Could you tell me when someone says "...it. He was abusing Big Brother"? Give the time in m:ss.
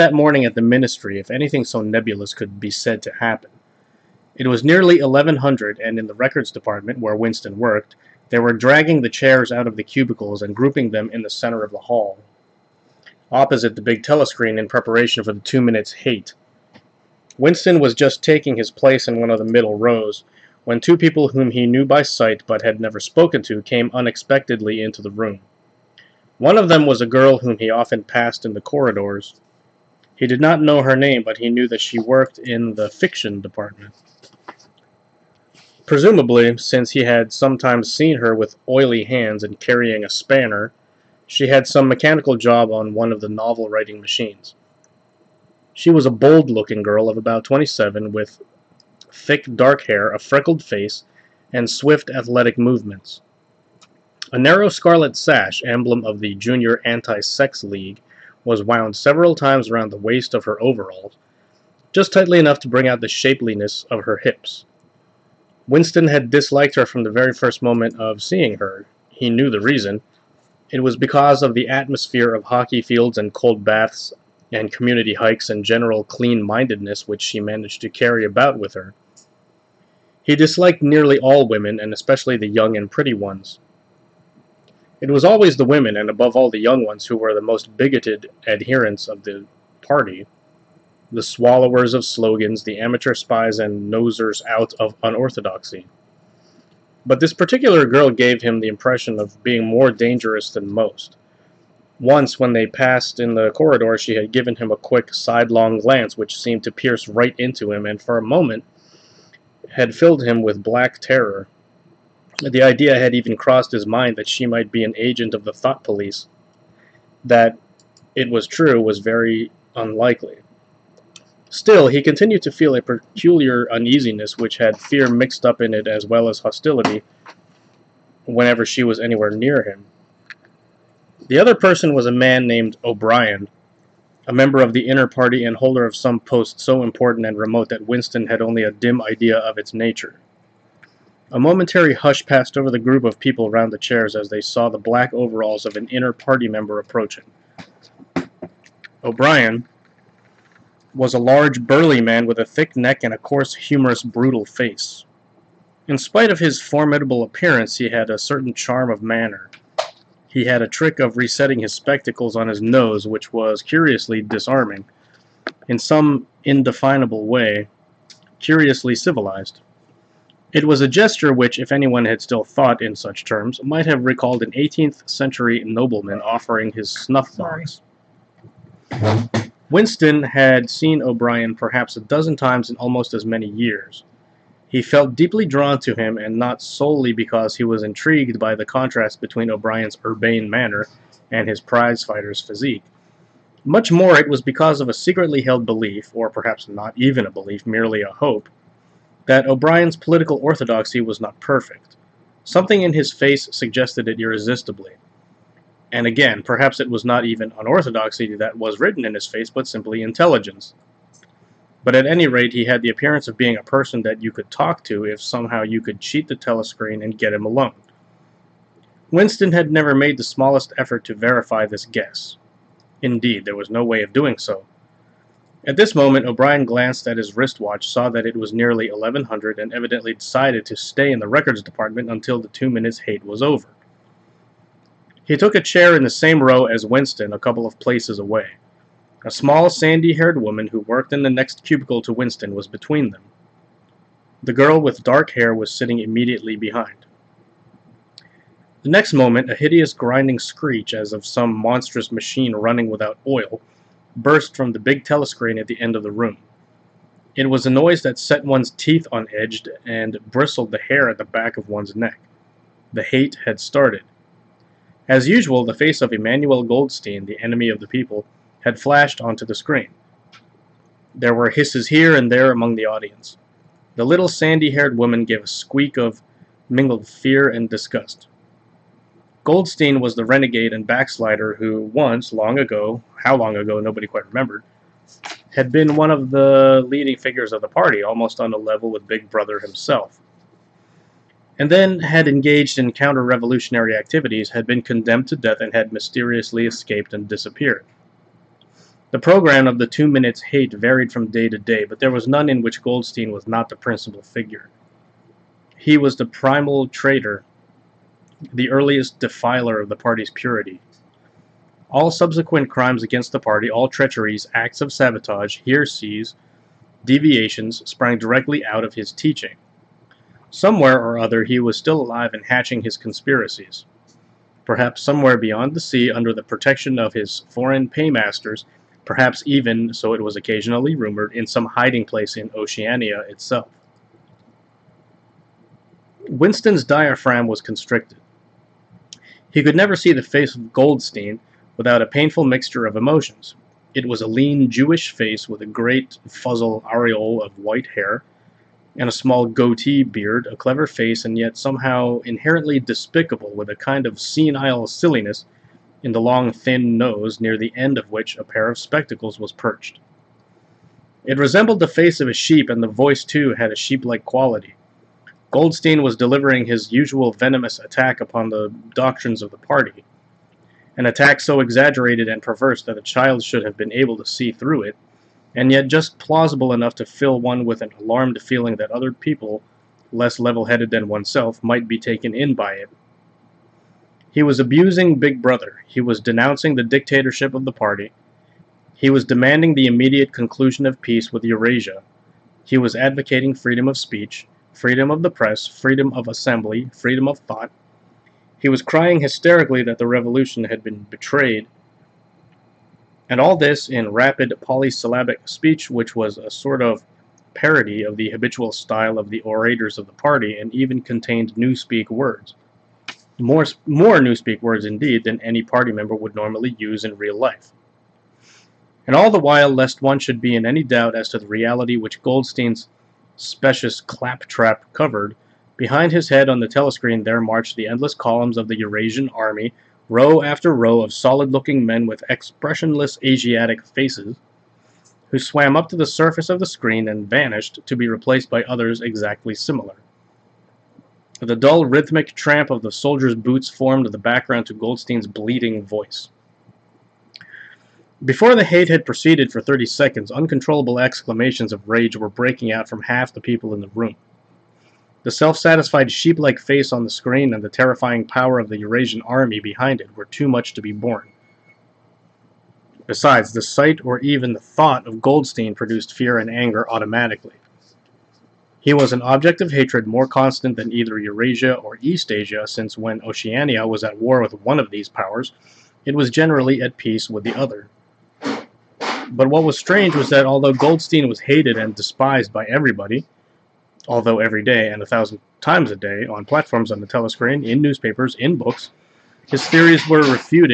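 6:22.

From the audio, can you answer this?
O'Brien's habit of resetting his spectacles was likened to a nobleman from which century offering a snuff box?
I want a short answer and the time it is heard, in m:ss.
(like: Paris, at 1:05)
18th century, at 2:54.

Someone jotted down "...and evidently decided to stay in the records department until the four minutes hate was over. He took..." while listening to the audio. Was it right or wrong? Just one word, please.
wrong.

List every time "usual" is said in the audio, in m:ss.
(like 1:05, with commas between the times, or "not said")
4:25, 6:06.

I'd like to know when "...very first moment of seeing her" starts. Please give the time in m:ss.
1:07.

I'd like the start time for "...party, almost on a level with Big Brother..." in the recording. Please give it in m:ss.
4:47.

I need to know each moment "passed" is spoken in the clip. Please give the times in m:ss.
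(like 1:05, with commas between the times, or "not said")
0:28, 1:42, 2:22.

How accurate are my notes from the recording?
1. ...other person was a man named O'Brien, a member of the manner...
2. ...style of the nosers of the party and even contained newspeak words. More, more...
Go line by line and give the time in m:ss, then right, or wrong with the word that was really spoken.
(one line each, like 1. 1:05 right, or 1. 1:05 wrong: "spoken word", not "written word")
1. 2:11 wrong: "inner", not "manner"
2. 6:48 wrong: "orators", not "nosers".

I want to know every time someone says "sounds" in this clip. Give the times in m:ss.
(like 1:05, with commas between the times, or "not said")
not said.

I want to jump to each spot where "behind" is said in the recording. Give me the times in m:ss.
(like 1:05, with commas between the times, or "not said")
4:06, 7:05, 7:39.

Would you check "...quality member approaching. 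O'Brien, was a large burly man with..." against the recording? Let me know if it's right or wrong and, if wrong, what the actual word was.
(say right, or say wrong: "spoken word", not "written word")
wrong: "party", not "quality".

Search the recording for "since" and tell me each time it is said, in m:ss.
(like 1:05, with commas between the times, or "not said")
0:36, 7:52.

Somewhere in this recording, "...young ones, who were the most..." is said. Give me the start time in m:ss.
1:26.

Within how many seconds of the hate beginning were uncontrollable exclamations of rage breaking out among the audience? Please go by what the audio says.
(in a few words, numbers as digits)
30.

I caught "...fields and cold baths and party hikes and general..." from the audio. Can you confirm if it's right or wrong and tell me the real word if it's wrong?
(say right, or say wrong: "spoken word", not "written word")
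wrong: "community", not "party".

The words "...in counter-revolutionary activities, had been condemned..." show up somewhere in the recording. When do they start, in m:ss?
4:52.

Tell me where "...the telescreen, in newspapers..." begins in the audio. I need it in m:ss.
8:06.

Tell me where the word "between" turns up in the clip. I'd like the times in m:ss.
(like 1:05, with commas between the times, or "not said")
3:09, 4:02.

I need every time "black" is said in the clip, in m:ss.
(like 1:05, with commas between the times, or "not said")
1:50, 2:24.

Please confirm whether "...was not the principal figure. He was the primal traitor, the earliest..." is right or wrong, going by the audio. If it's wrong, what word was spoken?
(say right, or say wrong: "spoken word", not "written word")
right.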